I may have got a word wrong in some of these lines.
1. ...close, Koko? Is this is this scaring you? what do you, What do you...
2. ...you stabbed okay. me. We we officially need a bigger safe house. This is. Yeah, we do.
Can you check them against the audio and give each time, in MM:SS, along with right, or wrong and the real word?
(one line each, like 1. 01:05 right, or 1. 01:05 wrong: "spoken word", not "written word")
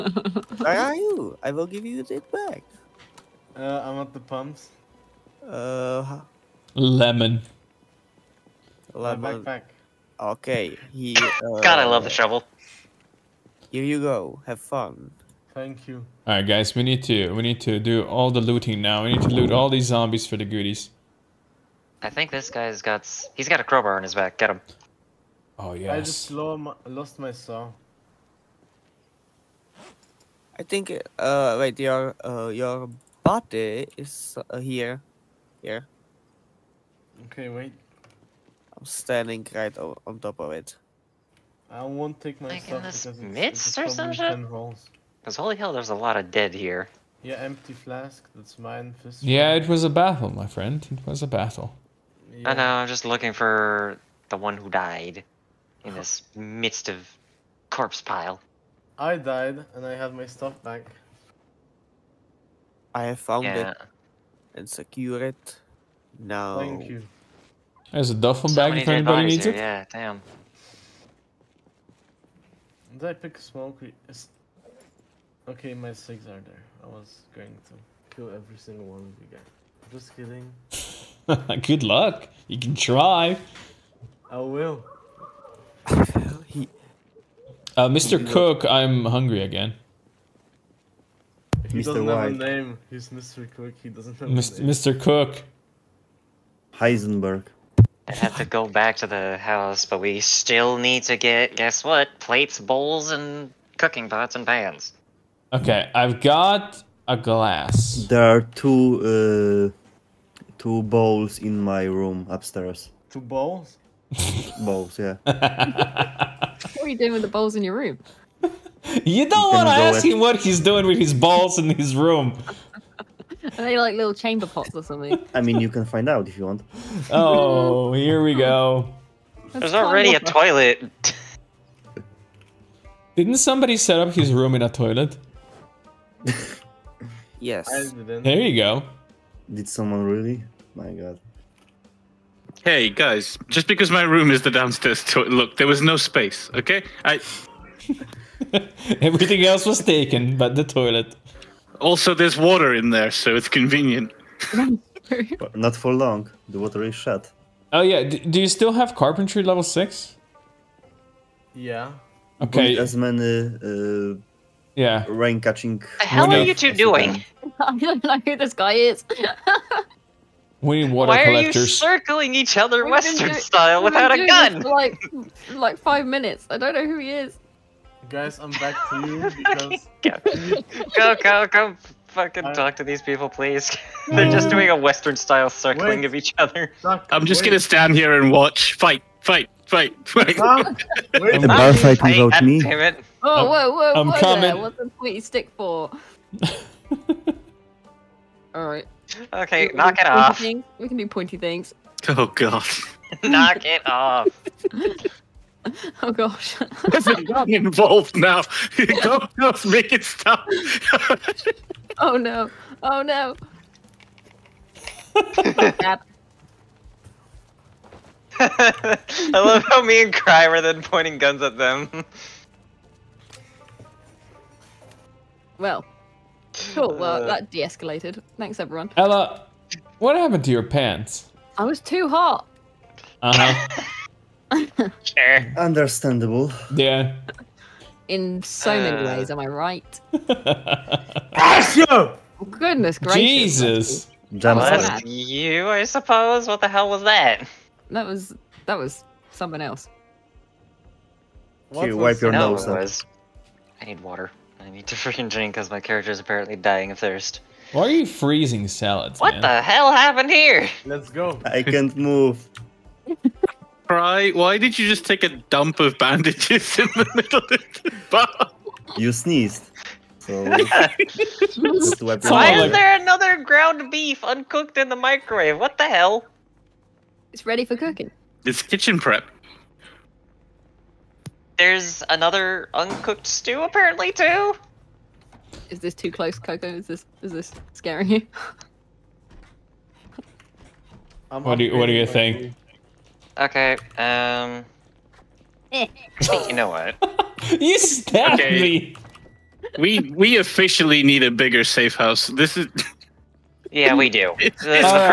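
1. 04:46 right
2. 04:57 right.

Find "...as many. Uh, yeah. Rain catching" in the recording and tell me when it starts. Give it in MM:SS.
02:42.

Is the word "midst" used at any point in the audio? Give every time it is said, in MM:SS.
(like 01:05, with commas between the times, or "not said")
00:43, 00:56.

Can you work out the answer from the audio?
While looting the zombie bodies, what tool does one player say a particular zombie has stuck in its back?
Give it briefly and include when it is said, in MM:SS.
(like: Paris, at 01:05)
crowbar, at 00:23.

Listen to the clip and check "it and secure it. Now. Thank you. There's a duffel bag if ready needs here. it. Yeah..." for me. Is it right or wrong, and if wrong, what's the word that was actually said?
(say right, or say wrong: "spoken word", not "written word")
wrong: "anybody", not "ready".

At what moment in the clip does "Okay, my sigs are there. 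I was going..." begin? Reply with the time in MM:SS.
01:15.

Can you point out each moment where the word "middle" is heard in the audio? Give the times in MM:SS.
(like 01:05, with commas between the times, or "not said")
04:27.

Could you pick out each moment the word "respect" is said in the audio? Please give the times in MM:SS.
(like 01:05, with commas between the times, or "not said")
not said.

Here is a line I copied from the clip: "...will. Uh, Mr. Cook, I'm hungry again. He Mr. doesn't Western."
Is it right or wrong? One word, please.
wrong.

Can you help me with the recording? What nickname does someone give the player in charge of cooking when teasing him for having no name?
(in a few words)
Heisenberg.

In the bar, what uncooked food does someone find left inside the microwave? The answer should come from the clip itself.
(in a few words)
ground beef.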